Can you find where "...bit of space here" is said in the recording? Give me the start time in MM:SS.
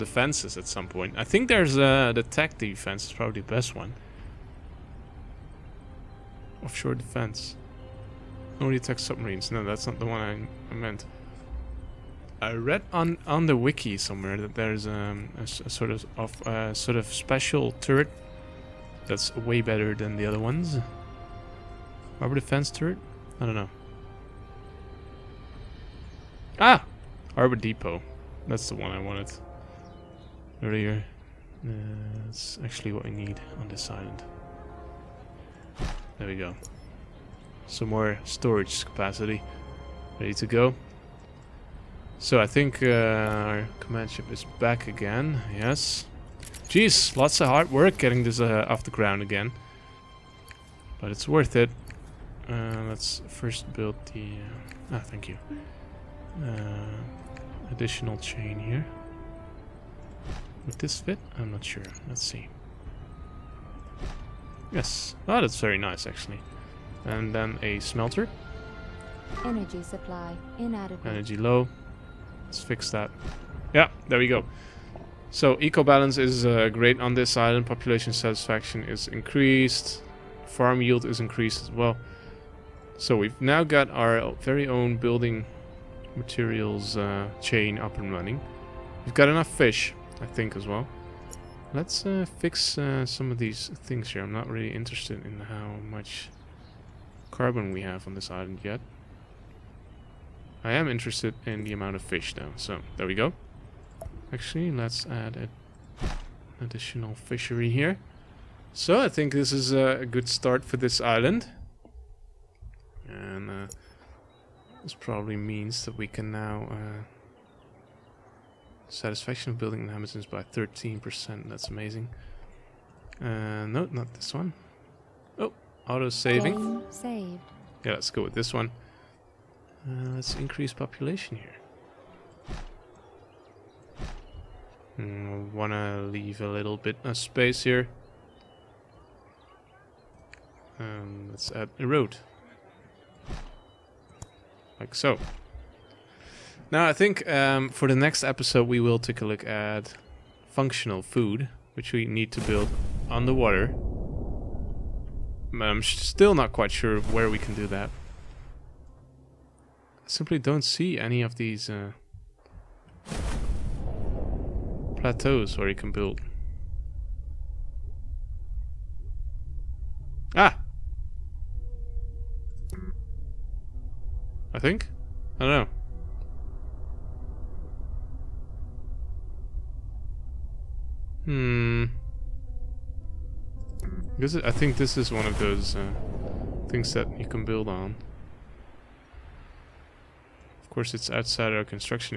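02:16.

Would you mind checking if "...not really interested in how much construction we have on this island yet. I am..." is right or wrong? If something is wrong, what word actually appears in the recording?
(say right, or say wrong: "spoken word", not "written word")
wrong: "carbon", not "construction".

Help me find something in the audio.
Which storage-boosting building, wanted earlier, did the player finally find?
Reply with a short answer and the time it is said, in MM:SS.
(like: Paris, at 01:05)
Harbor Depot, at 00:27.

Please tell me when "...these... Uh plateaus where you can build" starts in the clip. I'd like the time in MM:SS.
02:41.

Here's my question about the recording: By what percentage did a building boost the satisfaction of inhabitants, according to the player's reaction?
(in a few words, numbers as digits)
13%.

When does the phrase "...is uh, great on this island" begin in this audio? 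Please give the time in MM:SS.
01:16.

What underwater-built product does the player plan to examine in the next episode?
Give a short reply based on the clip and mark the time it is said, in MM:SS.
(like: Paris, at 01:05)
Functional food, at 02:30.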